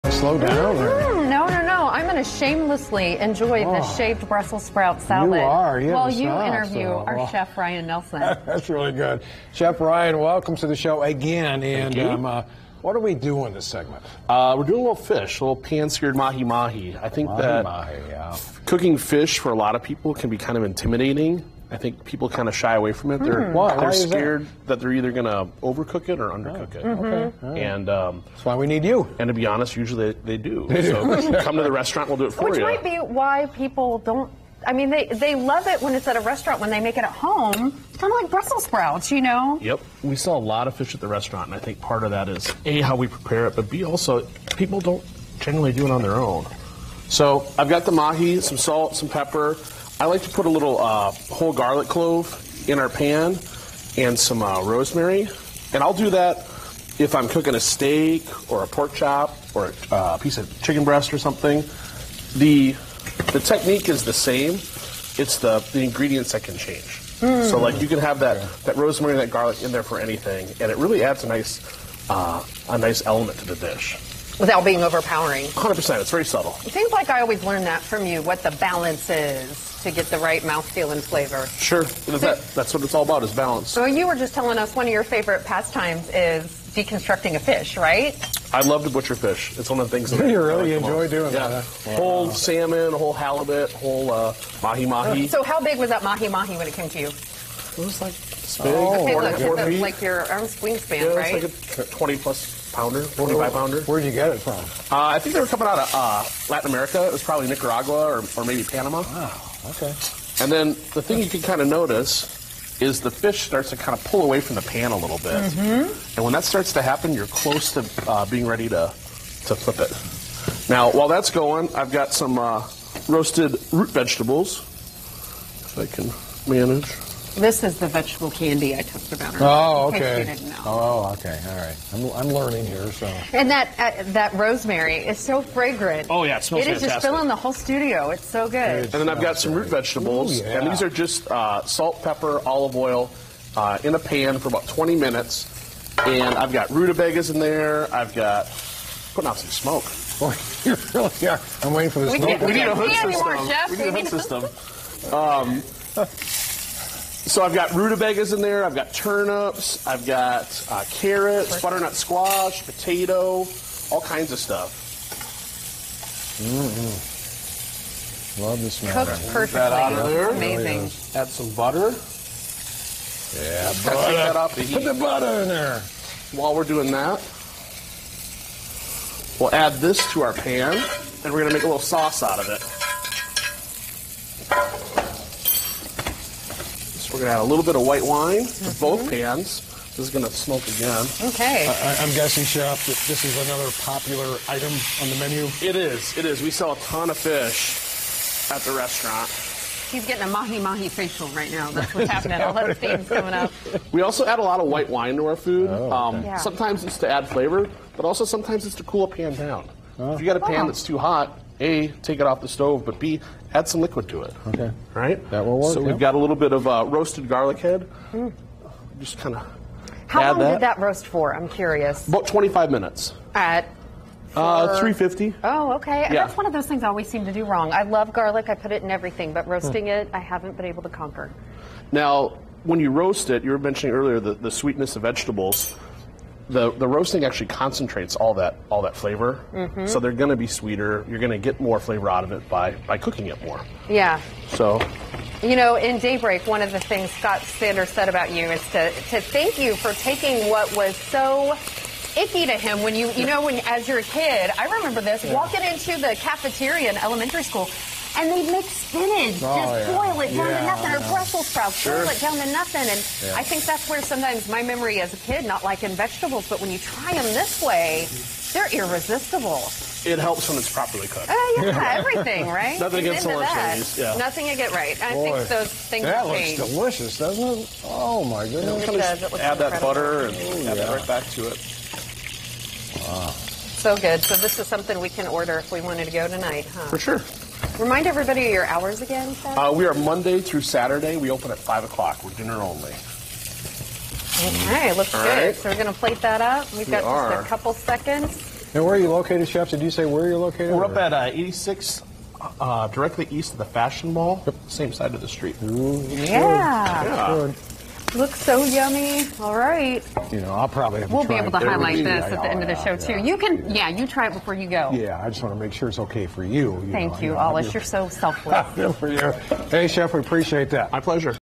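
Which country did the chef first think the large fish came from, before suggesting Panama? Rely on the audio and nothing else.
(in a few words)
Nicaragua.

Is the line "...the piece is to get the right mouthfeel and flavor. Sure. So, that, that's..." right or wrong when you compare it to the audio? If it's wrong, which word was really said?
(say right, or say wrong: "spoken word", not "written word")
wrong: "balance", not "piece".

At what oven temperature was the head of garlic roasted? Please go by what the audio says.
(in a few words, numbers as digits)
350.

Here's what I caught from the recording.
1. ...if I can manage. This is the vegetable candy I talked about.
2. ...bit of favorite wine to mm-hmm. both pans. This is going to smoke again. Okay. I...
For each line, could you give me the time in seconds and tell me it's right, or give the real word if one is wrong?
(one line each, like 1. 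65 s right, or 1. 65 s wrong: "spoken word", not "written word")
1. 125 s right
2. 187 s wrong: "white", not "favorite".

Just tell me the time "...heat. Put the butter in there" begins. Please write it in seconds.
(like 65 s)
174 s.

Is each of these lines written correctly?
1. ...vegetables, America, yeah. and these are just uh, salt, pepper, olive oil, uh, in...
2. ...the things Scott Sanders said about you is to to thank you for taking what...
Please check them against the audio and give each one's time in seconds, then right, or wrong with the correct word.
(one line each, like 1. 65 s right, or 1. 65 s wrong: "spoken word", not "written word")
1. 139 s wrong: "Ooh", not "America"
2. 246 s right.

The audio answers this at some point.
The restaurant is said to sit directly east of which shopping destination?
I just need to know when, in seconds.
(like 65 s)
303 s.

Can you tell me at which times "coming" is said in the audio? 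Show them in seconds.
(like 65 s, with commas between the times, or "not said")
105 s, 203 s.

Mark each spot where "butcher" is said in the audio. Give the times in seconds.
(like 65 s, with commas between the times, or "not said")
88 s.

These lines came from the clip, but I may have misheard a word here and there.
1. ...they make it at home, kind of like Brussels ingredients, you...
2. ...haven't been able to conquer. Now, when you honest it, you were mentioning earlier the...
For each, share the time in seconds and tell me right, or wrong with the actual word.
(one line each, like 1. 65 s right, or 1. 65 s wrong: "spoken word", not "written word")
1. 36 s wrong: "sprouts", not "ingredients"
2. 230 s wrong: "roast", not "honest".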